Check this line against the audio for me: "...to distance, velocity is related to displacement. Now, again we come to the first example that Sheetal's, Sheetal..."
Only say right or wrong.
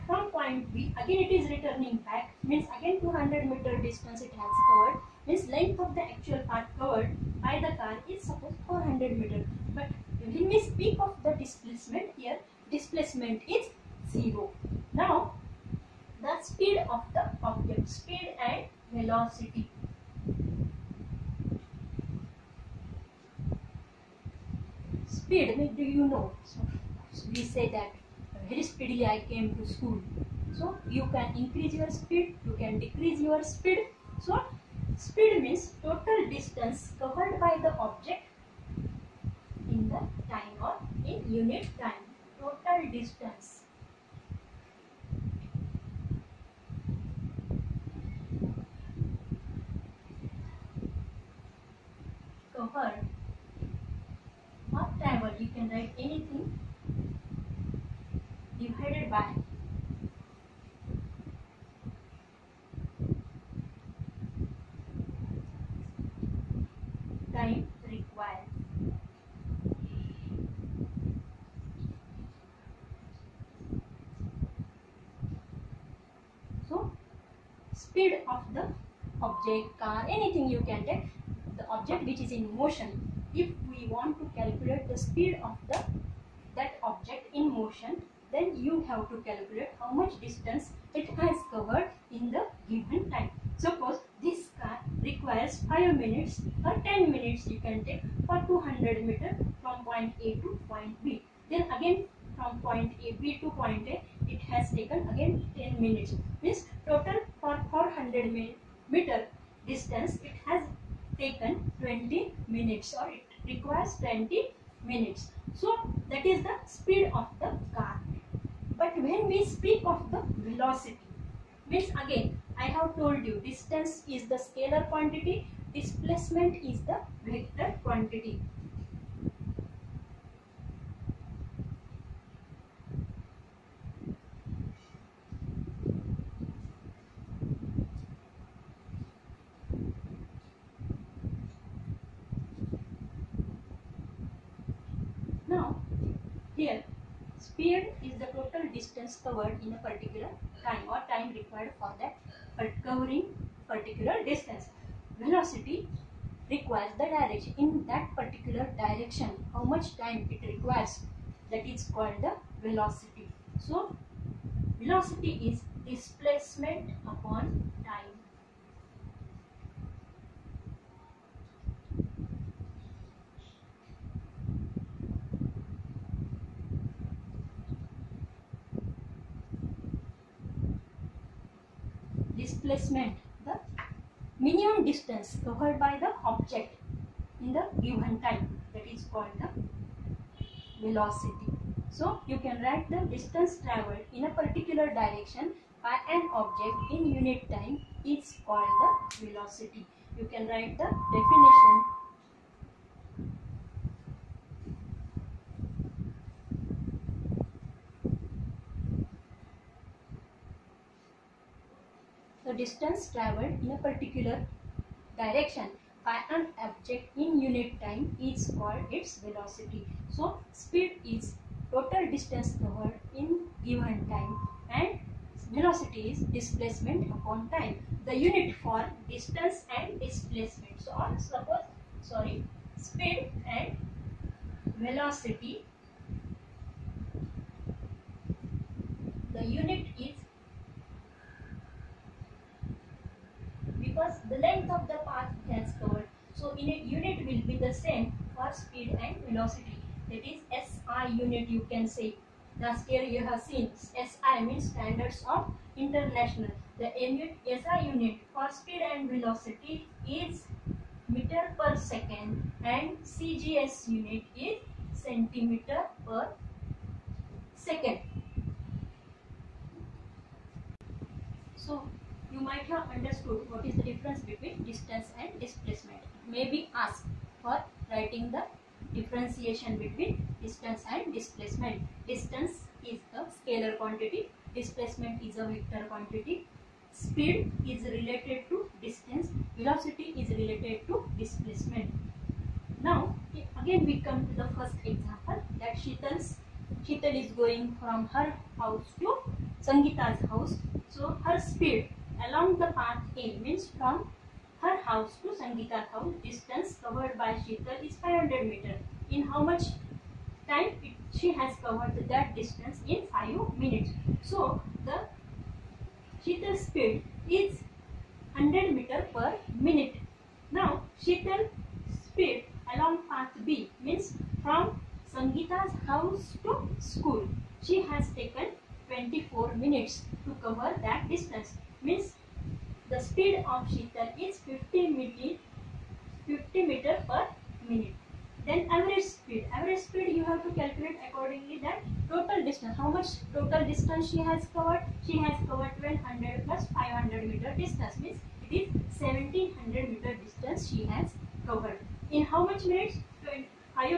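right.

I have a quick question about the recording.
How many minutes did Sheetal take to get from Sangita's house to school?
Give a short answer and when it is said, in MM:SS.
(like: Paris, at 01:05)
24 minutes, at 05:28.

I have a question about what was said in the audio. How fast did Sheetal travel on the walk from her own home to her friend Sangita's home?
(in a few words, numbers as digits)
100 meter per minute.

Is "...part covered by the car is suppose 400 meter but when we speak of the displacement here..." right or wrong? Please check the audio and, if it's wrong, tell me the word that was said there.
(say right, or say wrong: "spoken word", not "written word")
right.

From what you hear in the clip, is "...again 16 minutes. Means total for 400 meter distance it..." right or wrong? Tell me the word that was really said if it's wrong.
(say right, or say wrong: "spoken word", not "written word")
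wrong: "10", not "16".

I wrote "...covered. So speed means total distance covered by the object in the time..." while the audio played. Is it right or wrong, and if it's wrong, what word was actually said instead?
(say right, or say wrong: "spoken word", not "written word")
wrong: "speed", not "covered".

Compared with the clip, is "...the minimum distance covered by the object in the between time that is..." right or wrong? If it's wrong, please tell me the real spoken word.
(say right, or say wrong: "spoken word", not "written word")
wrong: "given", not "between".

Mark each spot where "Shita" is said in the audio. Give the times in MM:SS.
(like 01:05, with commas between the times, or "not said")
05:07, 05:16, 05:21.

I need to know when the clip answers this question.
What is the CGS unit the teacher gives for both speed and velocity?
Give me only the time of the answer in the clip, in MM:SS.
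04:25.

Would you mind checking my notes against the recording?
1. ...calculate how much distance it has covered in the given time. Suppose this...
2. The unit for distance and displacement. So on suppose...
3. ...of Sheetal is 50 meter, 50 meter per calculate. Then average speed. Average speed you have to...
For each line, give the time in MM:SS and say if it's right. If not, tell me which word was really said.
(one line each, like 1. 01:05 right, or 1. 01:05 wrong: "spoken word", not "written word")
1. 01:29 right
2. 03:48 right
3. 05:33 wrong: "minute", not "calculate".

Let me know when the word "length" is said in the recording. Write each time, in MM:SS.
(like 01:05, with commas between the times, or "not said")
00:05, 04:04.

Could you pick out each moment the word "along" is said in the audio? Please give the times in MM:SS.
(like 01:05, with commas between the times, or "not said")
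05:02, 05:22.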